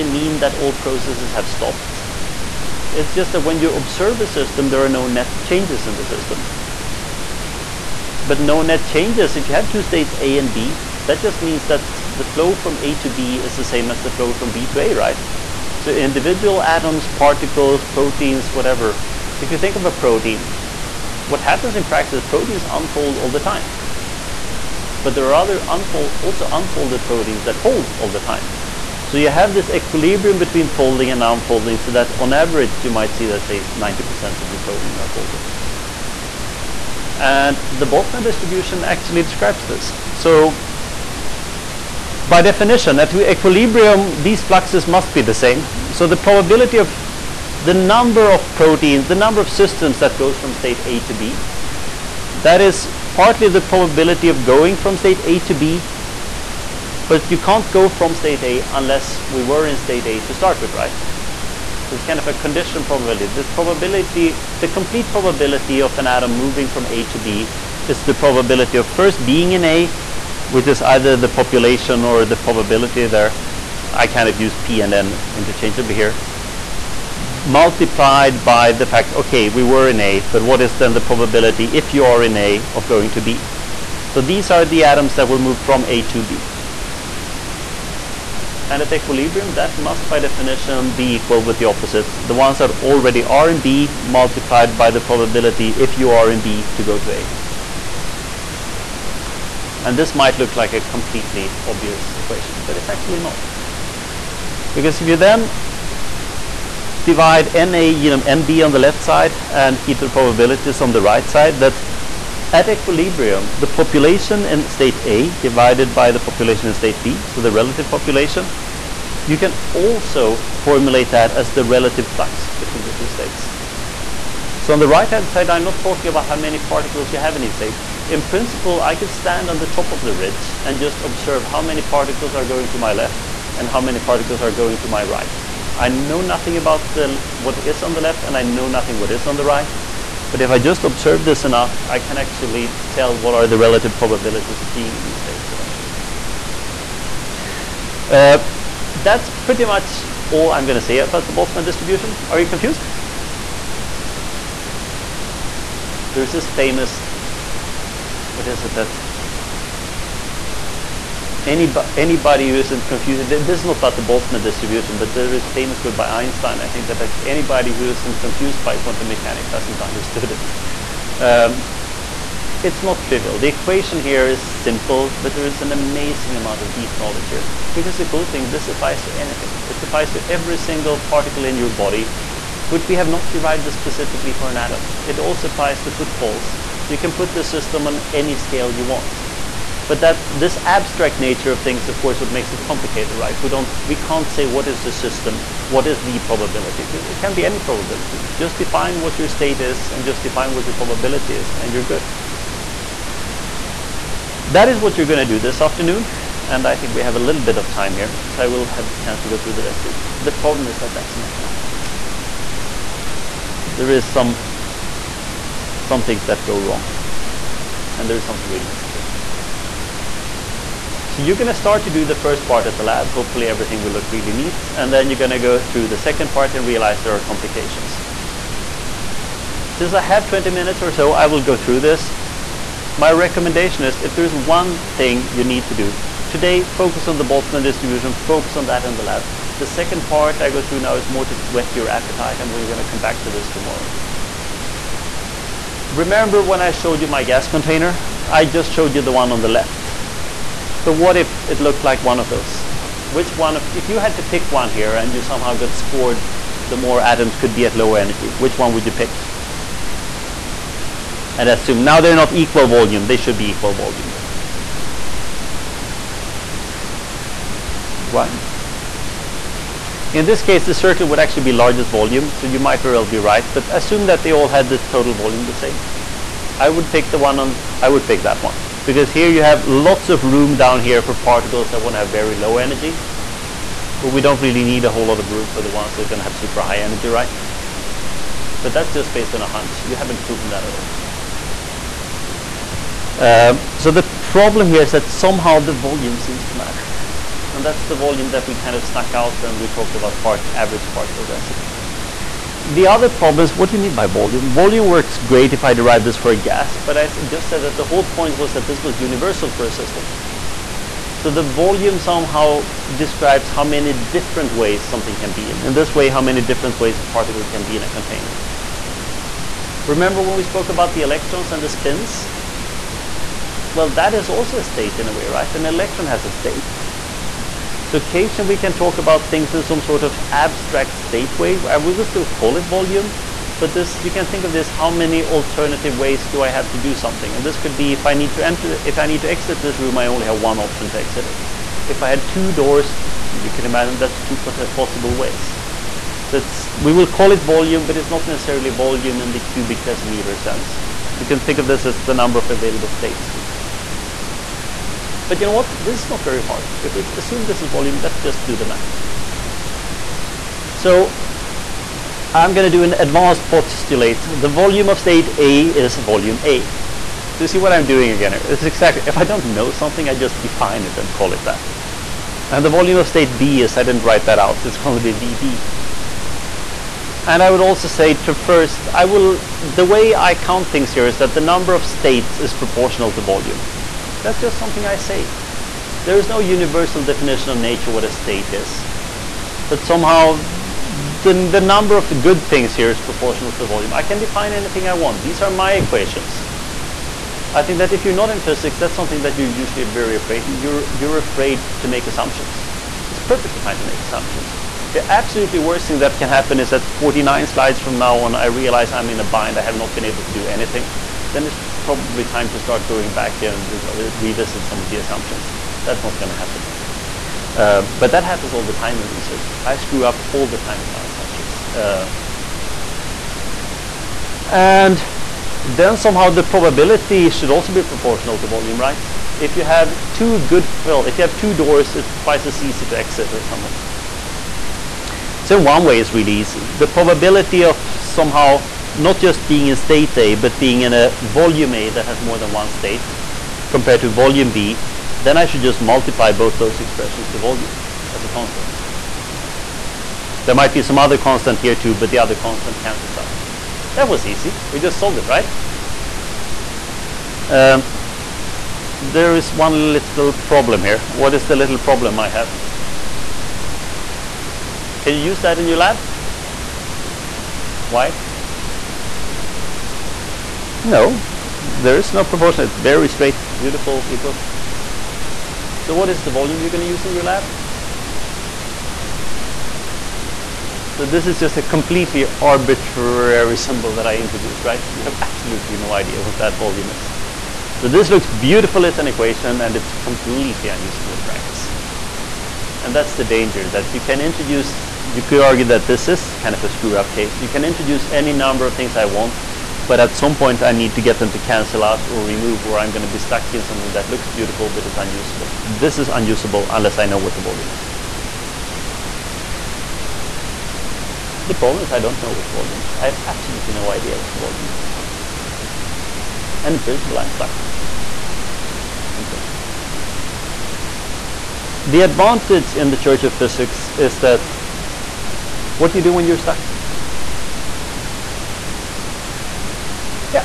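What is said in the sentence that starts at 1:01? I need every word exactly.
So it's kind of a condition probability.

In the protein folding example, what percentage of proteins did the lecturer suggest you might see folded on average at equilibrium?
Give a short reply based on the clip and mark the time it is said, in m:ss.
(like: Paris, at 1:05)
90%, at 0:33.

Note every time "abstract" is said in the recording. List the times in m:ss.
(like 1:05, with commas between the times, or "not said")
3:10, 5:30.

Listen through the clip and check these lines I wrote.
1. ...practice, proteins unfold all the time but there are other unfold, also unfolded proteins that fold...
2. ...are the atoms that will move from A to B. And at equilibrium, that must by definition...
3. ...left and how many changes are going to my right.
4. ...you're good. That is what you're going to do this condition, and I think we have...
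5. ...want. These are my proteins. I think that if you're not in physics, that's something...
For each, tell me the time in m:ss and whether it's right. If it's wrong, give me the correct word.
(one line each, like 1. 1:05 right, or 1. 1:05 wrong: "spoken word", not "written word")
1. 0:21 right
2. 1:24 right
3. 2:12 wrong: "particles", not "changes"
4. 3:21 wrong: "afternoon", not "condition"
5. 6:34 wrong: "equations", not "proteins".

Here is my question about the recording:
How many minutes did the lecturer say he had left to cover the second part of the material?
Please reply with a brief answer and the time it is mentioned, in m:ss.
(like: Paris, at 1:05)
20, at 3:50.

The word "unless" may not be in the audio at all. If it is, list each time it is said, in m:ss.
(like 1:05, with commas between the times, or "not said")
0:58, 8:26.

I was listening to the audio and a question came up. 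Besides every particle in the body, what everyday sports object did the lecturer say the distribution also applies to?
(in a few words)
footballs.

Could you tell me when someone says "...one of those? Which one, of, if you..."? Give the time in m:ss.
4:12.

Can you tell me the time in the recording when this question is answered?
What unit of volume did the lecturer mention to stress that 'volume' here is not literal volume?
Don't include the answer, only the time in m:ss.
5:49.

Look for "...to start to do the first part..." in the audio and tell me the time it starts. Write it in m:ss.
3:41.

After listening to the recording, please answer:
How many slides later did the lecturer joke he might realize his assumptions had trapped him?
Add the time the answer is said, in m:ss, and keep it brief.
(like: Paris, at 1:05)
49, at 6:46.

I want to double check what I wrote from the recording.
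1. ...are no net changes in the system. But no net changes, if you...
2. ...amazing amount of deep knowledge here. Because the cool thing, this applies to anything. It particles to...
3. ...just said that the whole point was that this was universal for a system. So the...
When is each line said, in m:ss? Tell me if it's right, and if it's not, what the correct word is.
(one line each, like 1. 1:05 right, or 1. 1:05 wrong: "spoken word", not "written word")
1. 0:04 right
2. 2:55 wrong: "applies", not "particles"
3. 5:07 right.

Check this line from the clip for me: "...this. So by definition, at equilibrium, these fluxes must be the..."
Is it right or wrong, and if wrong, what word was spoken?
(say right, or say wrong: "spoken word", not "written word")
right.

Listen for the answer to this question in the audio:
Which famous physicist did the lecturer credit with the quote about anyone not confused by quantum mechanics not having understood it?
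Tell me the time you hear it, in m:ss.
2:46.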